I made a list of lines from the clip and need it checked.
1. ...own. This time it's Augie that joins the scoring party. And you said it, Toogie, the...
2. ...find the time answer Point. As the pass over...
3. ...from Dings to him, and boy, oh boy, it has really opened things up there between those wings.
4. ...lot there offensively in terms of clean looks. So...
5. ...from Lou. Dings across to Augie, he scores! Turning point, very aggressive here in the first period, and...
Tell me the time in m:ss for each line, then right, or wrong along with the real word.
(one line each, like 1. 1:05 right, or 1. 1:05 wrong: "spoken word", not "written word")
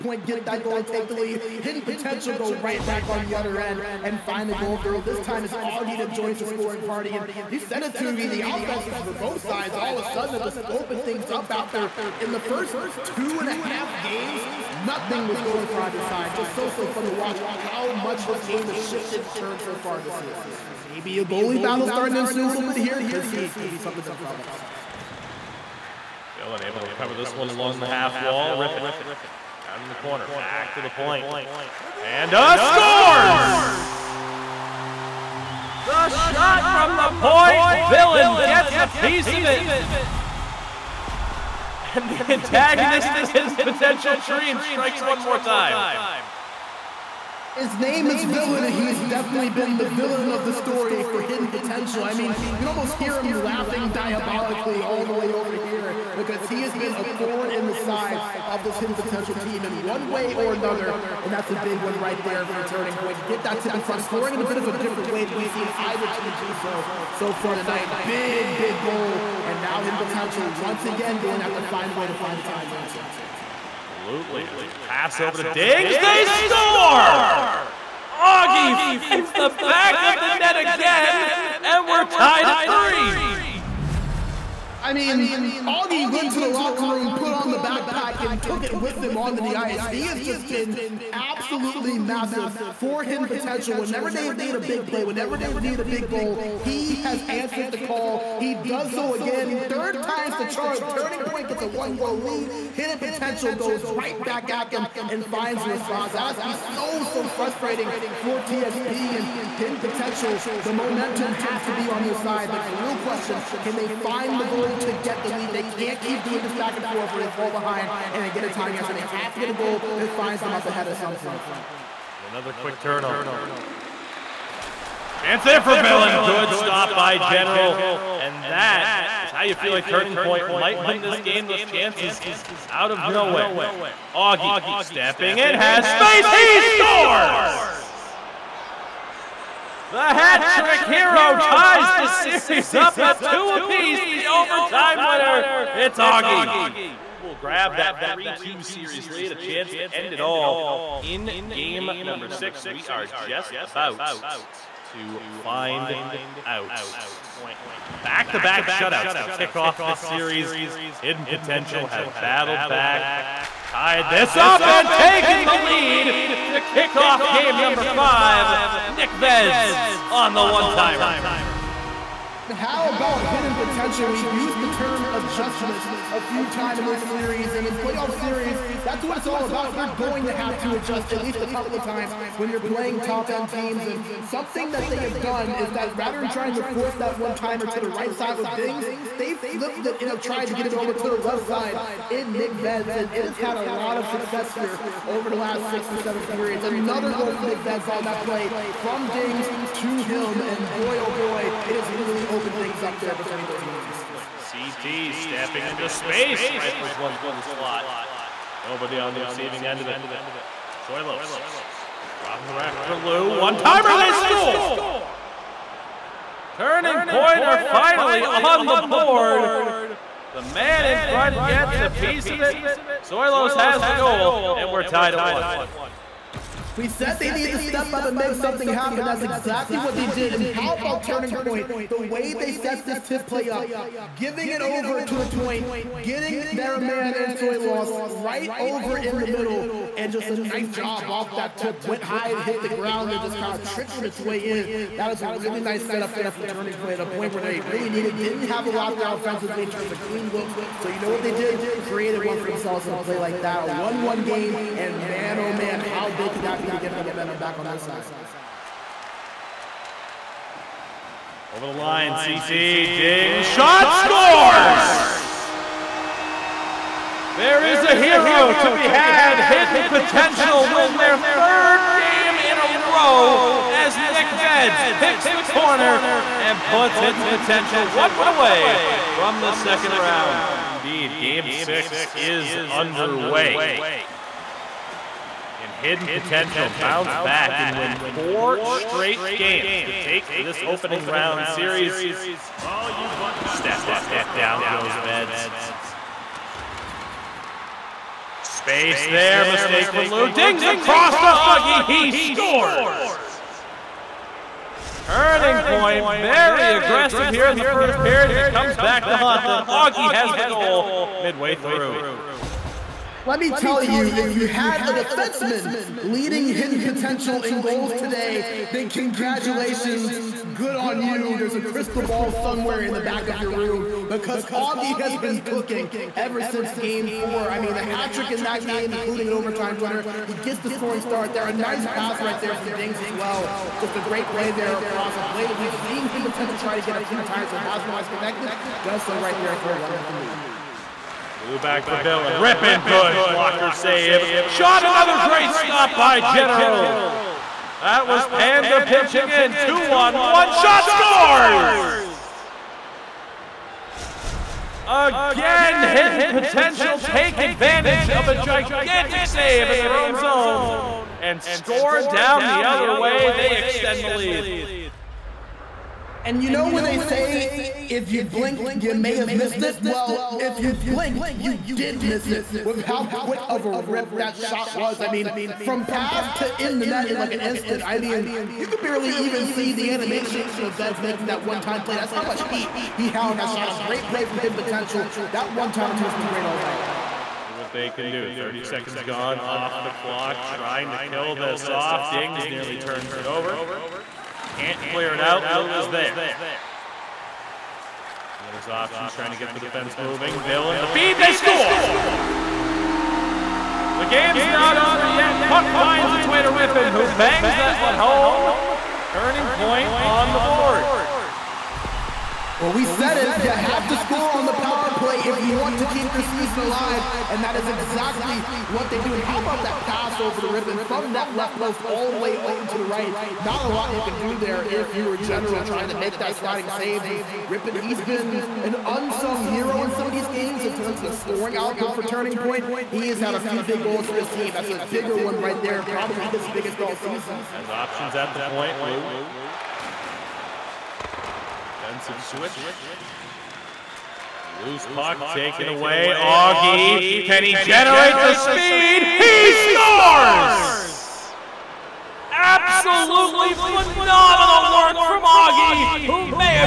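1. 0:04 right
2. 1:12 wrong: "Absolutely", not "Point"
3. 3:18 right
4. 4:08 right
5. 4:59 right.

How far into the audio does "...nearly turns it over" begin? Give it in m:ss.
6:32.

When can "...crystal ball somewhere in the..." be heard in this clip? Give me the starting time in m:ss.
5:21.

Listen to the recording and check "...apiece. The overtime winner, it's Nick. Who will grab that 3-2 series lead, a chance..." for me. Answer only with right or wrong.
wrong.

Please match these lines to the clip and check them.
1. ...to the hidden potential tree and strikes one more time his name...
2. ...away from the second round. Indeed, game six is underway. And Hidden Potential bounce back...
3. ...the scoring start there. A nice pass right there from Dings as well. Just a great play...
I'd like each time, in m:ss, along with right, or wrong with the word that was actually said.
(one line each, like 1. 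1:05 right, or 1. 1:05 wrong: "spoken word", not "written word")
1. 0:43 right
2. 4:38 right
3. 5:30 right.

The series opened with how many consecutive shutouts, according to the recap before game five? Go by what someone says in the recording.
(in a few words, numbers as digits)
3.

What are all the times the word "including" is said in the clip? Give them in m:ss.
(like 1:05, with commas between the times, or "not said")
5:28.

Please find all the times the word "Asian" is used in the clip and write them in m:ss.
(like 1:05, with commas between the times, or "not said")
not said.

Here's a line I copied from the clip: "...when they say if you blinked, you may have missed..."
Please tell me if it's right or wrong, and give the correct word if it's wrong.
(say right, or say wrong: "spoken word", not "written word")
right.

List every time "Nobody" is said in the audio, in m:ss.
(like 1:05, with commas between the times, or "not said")
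3:28.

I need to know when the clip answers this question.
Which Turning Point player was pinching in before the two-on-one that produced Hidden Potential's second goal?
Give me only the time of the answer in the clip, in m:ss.
5:47.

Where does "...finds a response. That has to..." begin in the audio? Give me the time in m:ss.
1:45.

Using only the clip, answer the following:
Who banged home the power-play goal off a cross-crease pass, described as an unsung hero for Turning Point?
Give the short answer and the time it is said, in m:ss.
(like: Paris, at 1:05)
Rippon, at 6:45.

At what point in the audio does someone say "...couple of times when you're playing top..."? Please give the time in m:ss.
3:01.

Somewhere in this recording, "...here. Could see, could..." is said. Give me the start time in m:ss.
0:22.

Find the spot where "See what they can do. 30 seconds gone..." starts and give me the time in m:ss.
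6:27.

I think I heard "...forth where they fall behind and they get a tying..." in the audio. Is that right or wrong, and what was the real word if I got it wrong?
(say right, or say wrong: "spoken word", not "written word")
right.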